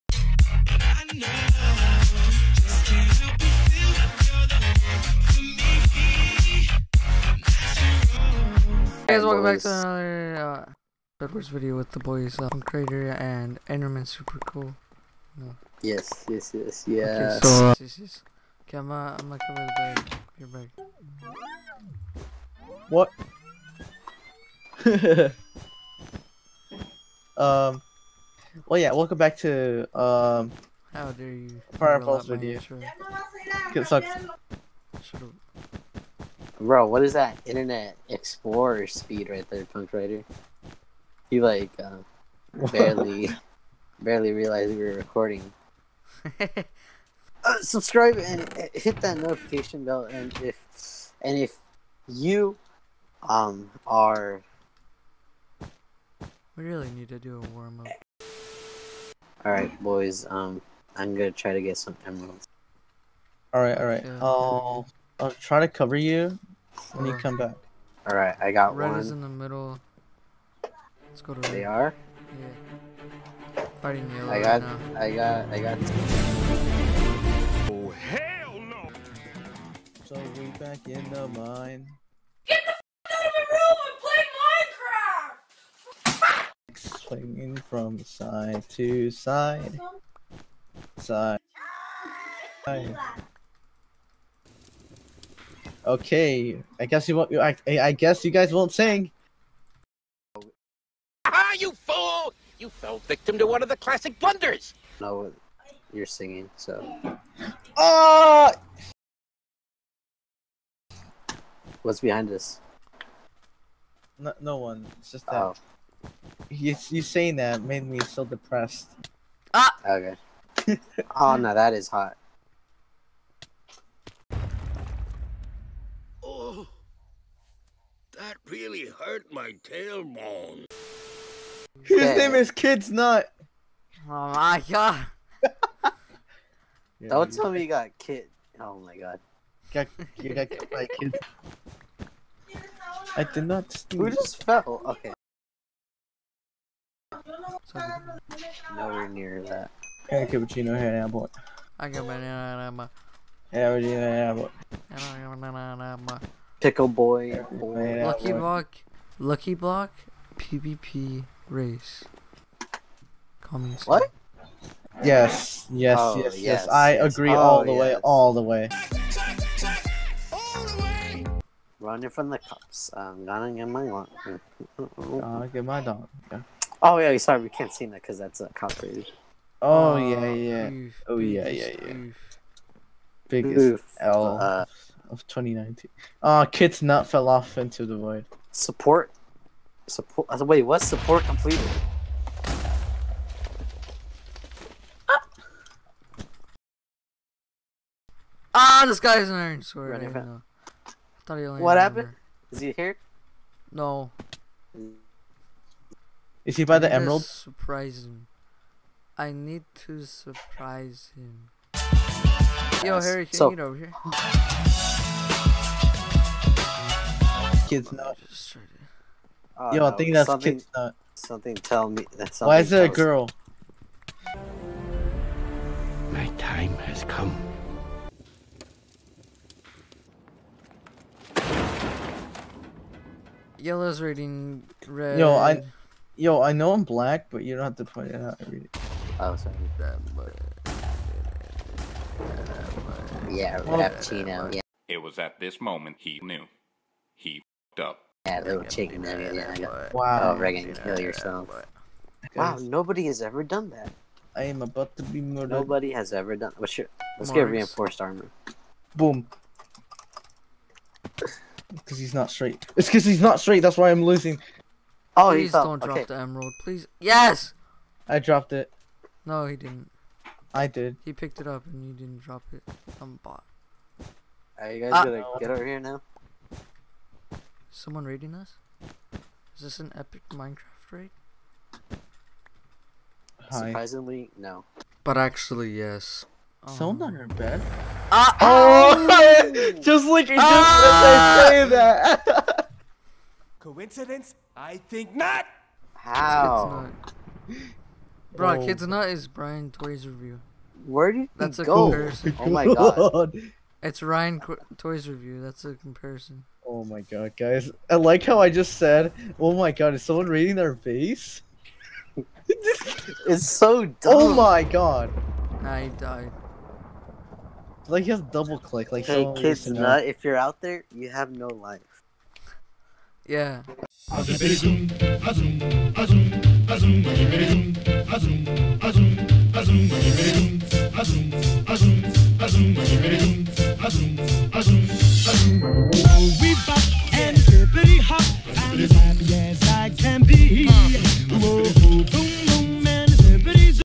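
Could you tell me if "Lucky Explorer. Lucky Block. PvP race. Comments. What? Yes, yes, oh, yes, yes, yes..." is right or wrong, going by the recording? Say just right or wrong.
wrong.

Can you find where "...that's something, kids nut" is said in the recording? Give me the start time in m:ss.
3:40.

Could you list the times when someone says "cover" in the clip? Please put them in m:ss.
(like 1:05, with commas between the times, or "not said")
0:19, 1:05.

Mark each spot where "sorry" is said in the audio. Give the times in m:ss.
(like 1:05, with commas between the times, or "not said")
2:57, 3:59.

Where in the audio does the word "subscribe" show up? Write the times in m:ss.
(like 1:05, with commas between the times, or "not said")
0:47.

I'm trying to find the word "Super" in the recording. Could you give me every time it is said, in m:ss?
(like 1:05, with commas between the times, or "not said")
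0:14.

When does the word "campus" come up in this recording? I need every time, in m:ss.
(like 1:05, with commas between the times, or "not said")
not said.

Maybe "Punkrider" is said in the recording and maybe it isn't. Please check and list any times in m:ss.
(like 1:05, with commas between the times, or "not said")
0:39.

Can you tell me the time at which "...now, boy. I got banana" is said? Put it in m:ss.
2:30.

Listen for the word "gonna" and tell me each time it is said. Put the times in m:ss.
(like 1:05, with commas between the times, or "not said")
0:19, 1:01, 2:53, 4:35.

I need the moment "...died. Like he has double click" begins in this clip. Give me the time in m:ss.
5:15.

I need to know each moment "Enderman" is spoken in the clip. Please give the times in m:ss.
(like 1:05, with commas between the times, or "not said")
0:13.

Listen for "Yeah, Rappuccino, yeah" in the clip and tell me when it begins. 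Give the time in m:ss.
4:03.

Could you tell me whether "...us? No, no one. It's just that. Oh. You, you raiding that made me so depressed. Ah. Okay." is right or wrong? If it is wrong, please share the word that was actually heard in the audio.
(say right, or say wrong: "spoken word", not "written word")
wrong: "saying", not "raiding".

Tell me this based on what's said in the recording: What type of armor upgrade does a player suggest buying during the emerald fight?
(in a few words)
Reinforced armor.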